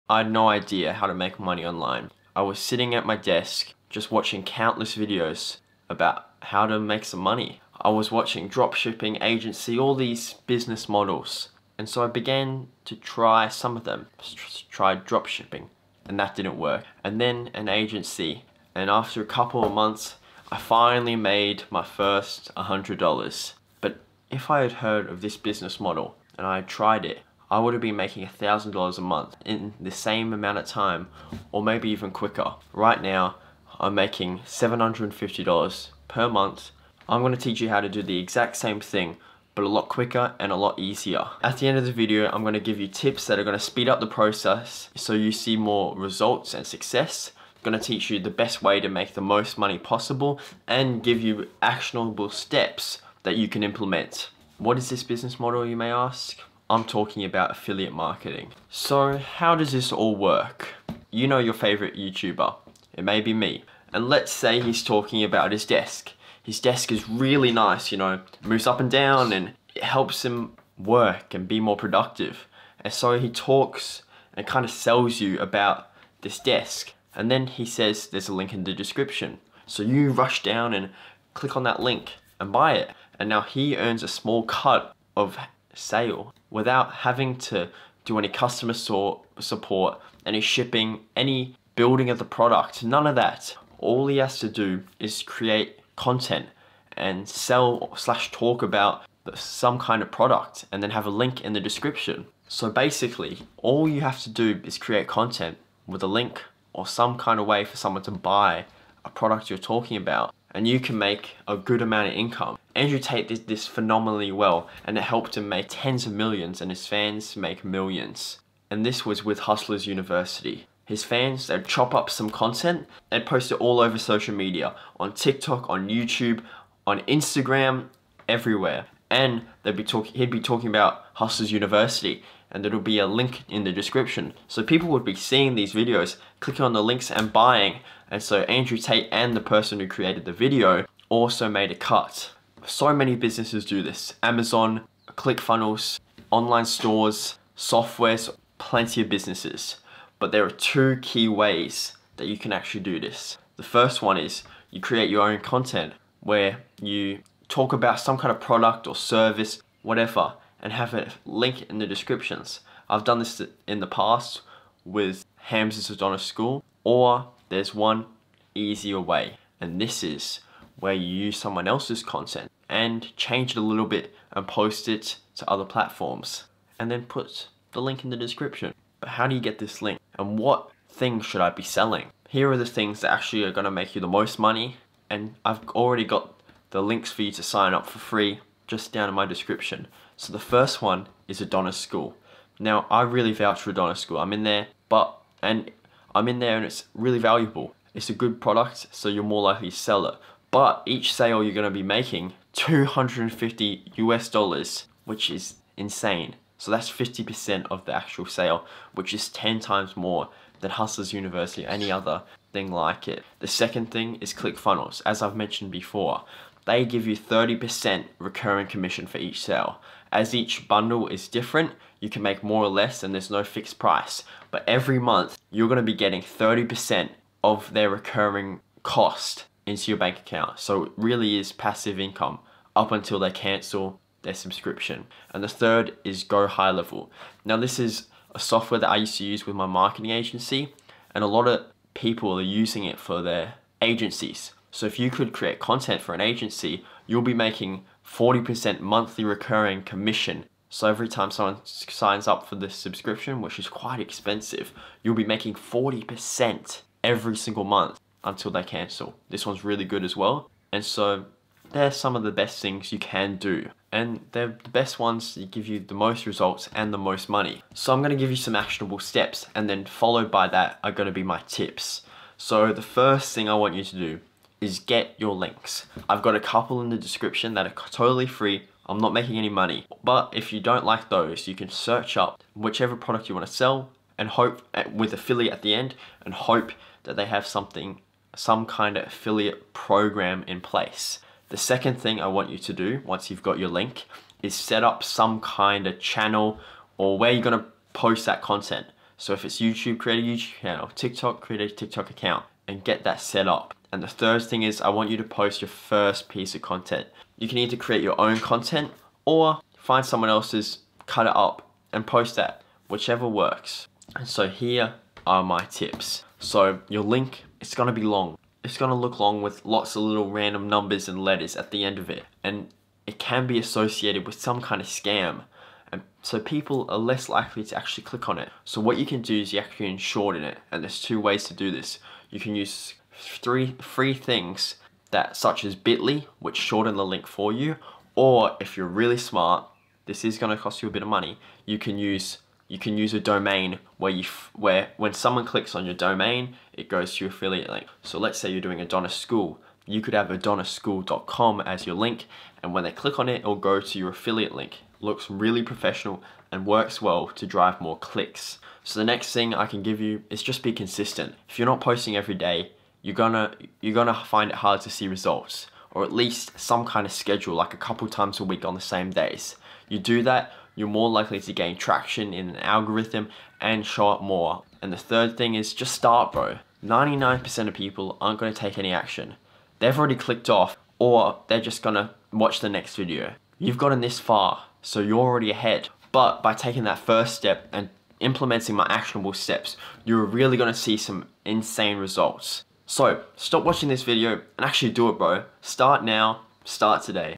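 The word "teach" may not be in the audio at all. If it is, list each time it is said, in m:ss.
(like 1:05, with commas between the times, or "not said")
0:37, 0:47.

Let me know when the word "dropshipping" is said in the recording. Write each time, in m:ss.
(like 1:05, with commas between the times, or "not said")
0:08, 0:15.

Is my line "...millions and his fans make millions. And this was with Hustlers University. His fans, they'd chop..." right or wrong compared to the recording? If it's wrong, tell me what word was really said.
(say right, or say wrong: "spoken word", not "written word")
right.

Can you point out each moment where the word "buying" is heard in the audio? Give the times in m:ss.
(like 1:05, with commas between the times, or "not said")
2:17.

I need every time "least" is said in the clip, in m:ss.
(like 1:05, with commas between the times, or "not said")
6:06.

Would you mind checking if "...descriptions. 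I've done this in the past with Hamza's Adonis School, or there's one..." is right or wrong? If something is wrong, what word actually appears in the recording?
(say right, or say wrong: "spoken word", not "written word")
right.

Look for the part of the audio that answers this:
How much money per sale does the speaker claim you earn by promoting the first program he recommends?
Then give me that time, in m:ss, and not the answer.
3:22.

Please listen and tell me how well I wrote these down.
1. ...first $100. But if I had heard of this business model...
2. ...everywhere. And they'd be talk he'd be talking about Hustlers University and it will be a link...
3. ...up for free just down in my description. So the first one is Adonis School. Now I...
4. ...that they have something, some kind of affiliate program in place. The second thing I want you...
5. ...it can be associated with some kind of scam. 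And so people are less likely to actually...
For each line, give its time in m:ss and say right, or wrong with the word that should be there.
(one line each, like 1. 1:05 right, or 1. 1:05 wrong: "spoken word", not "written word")
1. 0:21 right
2. 2:08 right
3. 3:07 right
4. 4:47 right
5. 5:23 right.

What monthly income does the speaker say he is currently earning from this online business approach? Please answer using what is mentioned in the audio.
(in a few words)
$750.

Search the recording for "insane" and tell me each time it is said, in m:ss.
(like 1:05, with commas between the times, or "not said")
3:25, 6:31.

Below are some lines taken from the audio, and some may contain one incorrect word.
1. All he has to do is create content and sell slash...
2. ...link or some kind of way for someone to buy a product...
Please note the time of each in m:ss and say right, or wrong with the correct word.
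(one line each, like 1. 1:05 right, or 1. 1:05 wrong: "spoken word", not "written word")
1. 1:33 right
2. 1:46 right.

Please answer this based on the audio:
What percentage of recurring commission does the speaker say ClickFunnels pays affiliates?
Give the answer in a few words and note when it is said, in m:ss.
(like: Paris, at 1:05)
30%, at 3:37.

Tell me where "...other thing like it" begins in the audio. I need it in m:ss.
3:31.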